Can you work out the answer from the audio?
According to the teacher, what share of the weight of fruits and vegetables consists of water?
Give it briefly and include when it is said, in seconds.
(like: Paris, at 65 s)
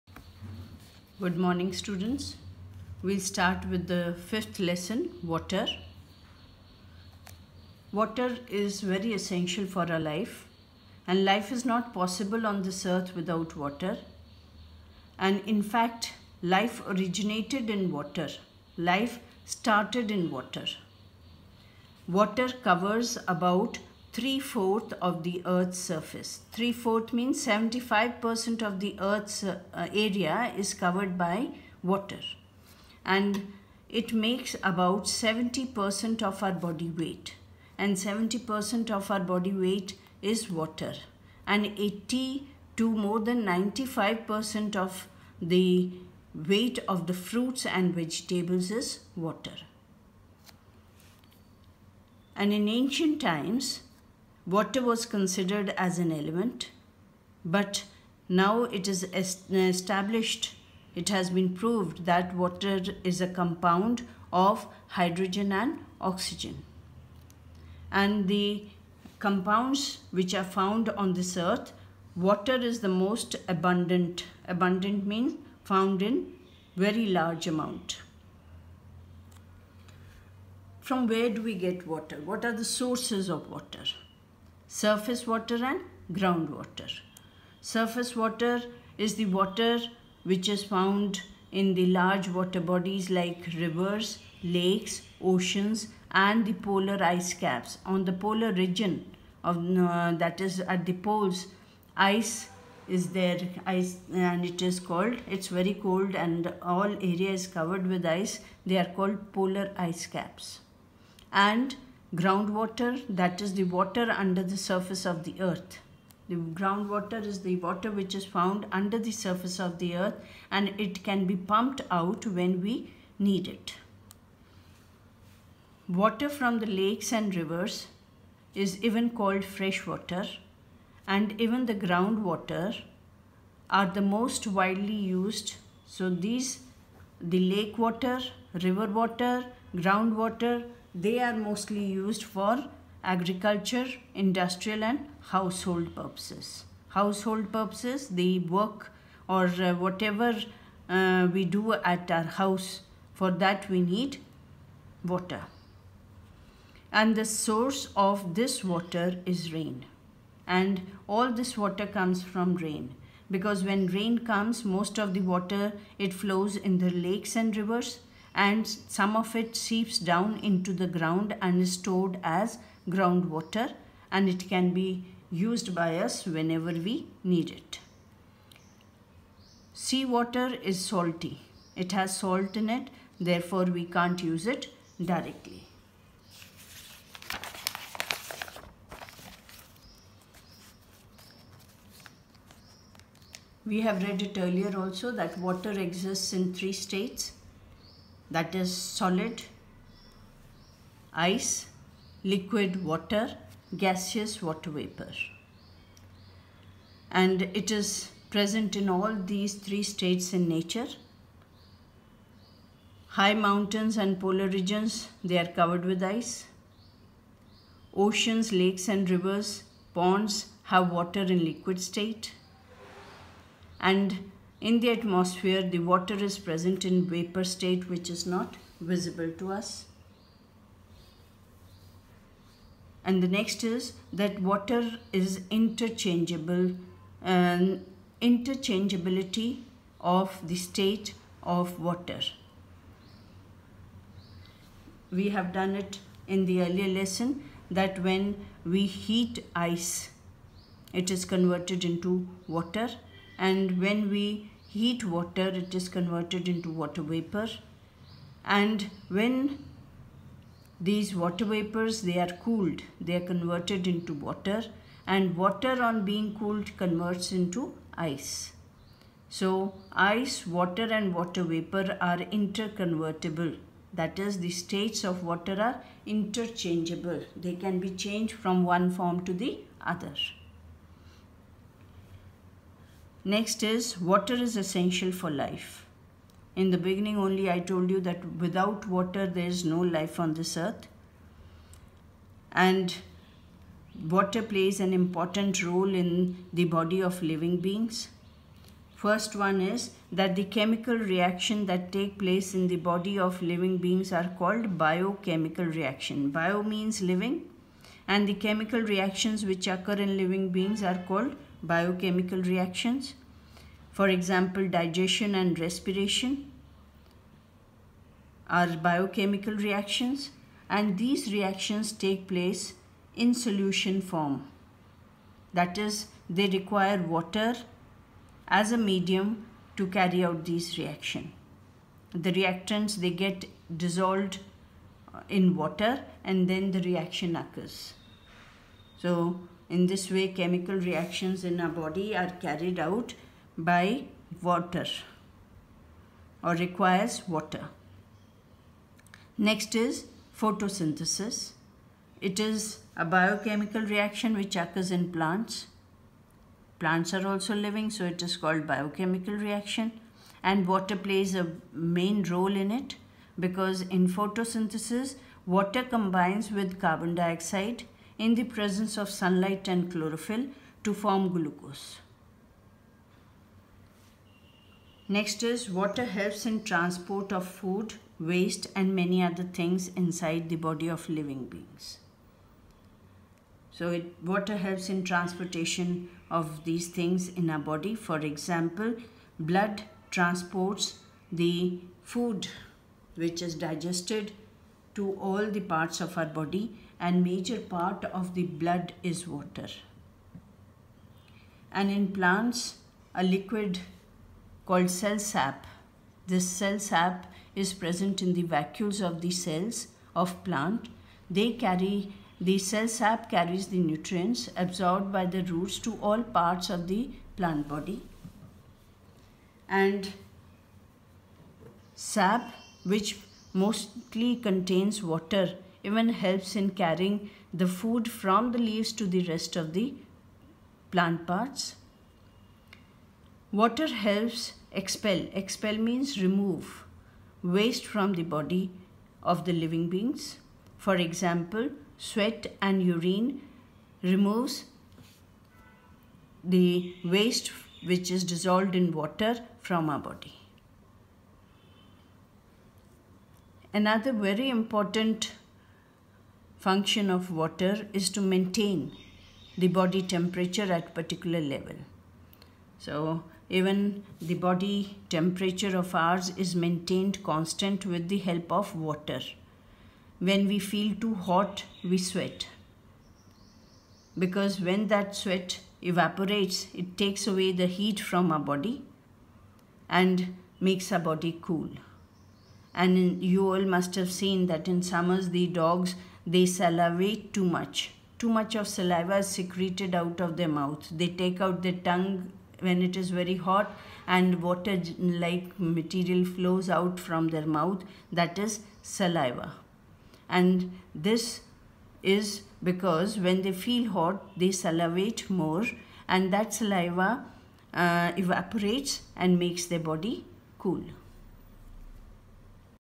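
80 to more than 95%, at 41 s.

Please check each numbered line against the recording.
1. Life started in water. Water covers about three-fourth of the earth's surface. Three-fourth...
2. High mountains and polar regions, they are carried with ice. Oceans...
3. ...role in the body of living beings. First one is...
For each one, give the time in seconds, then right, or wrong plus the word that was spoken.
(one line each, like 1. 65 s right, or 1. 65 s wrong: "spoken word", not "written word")
1. 18 s right
2. 213 s wrong: "covered", not "carried"
3. 295 s right.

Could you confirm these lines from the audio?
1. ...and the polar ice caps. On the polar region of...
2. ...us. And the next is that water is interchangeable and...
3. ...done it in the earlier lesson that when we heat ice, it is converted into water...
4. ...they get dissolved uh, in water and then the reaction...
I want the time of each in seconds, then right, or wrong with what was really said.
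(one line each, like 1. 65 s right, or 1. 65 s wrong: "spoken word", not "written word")
1. 96 s right
2. 229 s right
3. 245 s right
4. 332 s right.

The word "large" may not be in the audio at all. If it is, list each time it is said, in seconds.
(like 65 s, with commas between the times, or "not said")
77 s, 91 s.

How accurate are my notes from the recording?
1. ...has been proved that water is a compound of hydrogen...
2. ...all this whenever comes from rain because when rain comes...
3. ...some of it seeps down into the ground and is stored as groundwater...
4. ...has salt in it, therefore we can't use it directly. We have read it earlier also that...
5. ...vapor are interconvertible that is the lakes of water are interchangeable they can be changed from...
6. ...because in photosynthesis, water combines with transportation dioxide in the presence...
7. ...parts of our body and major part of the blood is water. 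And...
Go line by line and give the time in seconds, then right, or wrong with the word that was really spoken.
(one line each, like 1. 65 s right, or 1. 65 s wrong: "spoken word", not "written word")
1. 61 s right
2. 161 s wrong: "water", not "whenever"
3. 168 s right
4. 181 s right
5. 271 s wrong: "states", not "lakes"
6. 363 s wrong: "carbon", not "transportation"
7. 395 s right.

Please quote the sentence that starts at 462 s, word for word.
So even the body temperature of ours is maintained constant with the help of water.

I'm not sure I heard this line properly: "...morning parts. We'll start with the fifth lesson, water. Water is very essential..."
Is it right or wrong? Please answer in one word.
wrong.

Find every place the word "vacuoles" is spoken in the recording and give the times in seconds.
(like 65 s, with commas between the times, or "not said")
408 s.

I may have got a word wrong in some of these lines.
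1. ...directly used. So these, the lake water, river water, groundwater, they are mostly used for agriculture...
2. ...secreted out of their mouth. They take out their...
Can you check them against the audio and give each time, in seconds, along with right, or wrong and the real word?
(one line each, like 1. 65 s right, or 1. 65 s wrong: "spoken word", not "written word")
1. 134 s wrong: "widely", not "directly"
2. 489 s right.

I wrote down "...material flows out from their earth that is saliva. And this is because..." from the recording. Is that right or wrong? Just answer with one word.
wrong.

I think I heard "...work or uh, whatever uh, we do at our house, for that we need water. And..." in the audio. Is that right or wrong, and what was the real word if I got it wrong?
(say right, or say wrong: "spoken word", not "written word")
right.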